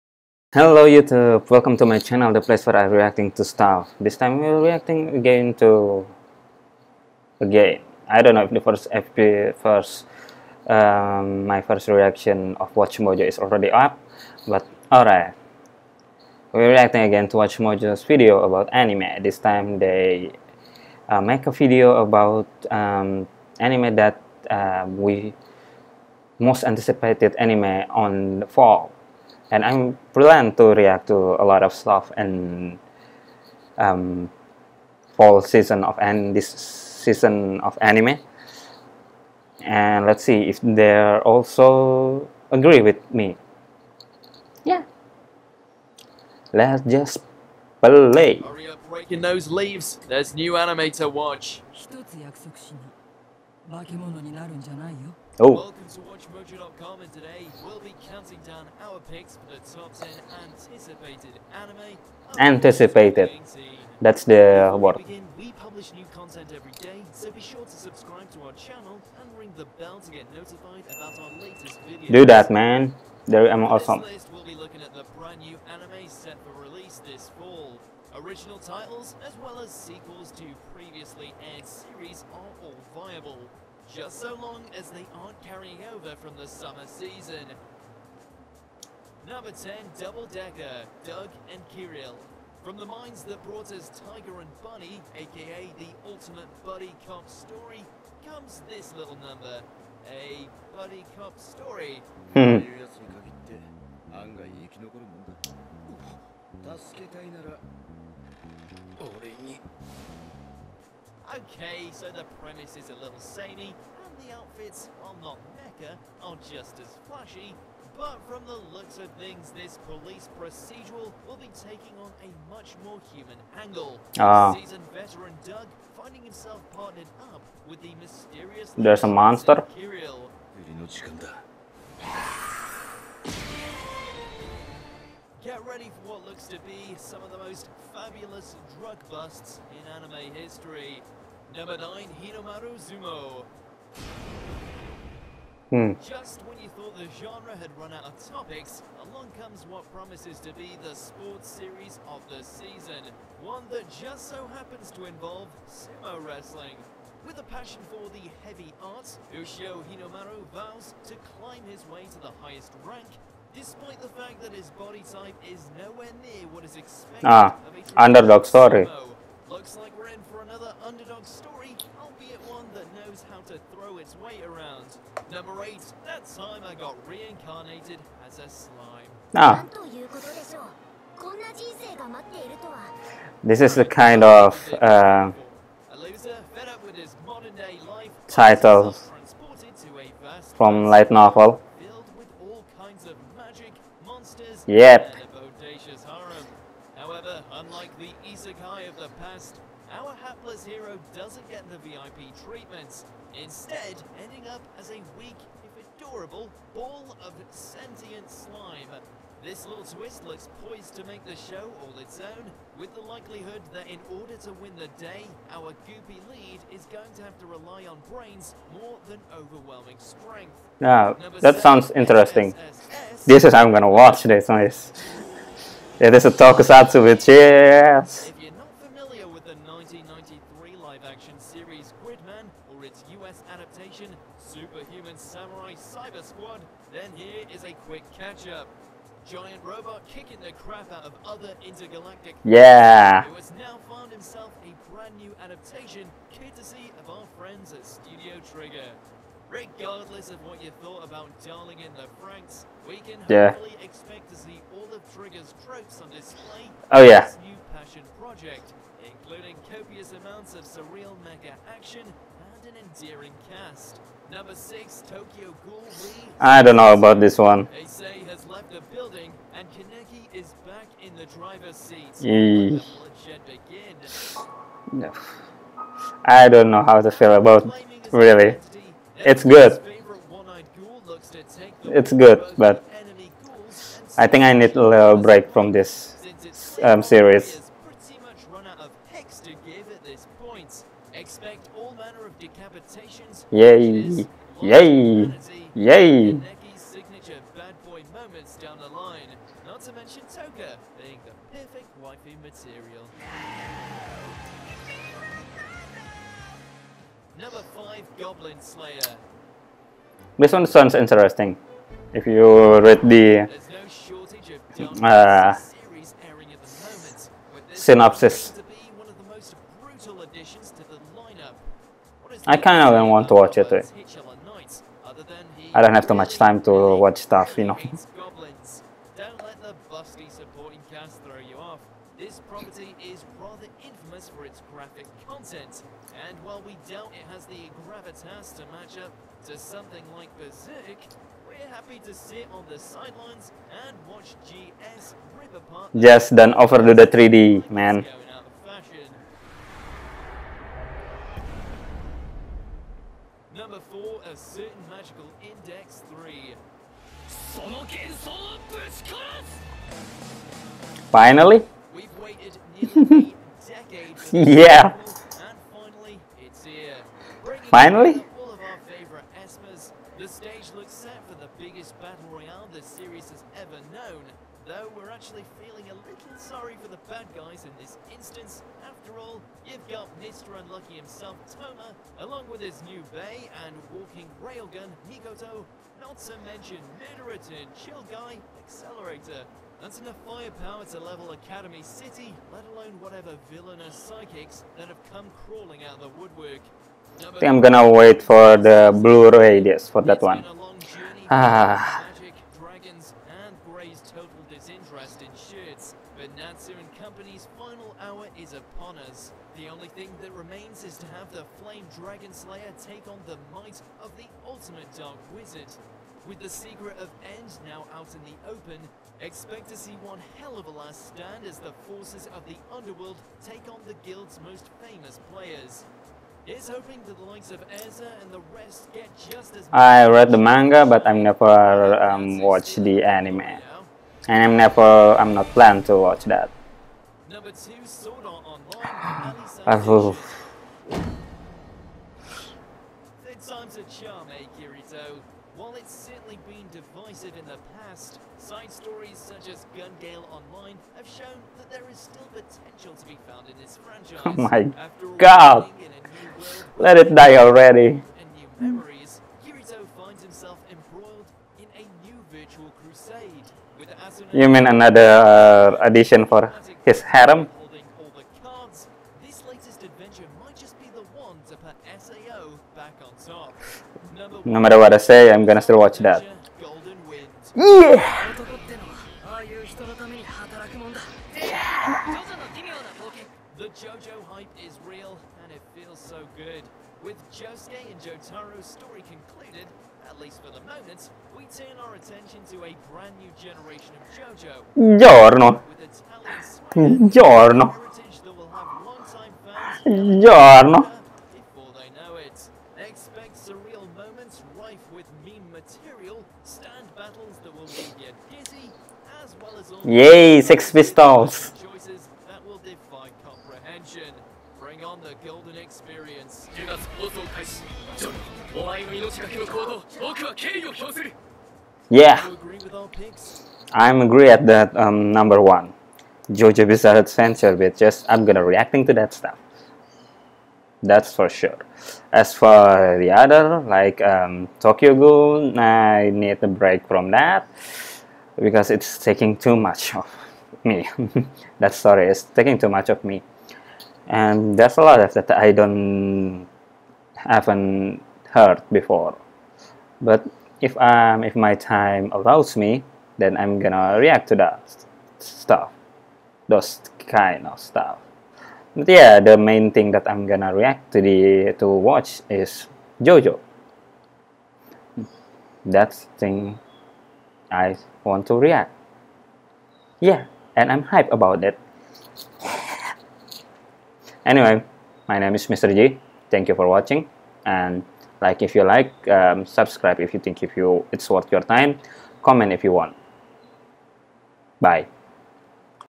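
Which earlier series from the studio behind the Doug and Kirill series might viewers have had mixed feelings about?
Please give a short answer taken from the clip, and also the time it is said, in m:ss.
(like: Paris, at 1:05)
Darling in the Franxx, at 4:11.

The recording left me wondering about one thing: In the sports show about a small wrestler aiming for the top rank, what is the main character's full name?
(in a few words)
Ushio Hinomaru.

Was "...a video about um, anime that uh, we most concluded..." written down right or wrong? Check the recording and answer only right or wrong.
wrong.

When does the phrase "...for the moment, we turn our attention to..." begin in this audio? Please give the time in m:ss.
8:10.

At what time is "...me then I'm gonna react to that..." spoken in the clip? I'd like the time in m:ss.
9:12.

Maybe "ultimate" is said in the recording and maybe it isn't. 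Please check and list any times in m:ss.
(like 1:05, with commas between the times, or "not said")
1:36, 6:54.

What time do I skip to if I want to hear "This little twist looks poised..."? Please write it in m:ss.
3:29.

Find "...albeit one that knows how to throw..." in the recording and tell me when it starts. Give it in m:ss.
2:52.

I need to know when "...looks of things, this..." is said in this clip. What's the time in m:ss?
1:58.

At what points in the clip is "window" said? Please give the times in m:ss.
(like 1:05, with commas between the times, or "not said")
not said.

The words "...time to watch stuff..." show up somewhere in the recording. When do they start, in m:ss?
5:26.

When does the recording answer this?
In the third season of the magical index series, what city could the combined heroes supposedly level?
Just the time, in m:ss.
6:31.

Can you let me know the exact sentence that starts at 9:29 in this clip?
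Yeah, and I'm hype about it.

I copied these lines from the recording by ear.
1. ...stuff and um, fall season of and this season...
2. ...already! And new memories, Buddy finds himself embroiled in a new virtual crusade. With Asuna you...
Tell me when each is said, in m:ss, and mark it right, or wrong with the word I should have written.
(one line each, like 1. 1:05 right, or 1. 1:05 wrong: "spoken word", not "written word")
1. 0:31 right
2. 7:37 wrong: "Kirito", not "Buddy".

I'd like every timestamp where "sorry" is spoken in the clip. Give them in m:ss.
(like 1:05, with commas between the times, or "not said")
2:48, 6:16.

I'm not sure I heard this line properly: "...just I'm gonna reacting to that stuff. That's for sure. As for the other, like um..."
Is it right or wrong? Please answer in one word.
right.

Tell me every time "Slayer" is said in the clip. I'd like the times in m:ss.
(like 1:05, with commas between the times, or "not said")
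5:08, 6:52.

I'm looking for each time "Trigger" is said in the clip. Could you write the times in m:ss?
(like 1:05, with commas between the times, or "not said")
4:08, 4:15.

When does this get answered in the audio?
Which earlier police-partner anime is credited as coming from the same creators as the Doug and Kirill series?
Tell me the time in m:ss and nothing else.
1:34.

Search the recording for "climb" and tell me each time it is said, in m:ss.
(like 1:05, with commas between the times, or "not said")
2:41.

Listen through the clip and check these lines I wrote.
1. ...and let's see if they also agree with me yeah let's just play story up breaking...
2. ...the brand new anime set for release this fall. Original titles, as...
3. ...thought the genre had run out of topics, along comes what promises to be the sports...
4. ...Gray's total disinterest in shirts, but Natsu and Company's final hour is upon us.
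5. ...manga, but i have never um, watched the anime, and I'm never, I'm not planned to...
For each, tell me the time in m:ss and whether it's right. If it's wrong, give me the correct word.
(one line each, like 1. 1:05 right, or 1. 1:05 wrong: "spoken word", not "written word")
1. 0:39 wrong: "hurry", not "story"
2. 1:14 right
3. 2:26 right
4. 6:43 right
5. 7:10 right.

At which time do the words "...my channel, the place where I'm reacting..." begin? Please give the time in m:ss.
0:01.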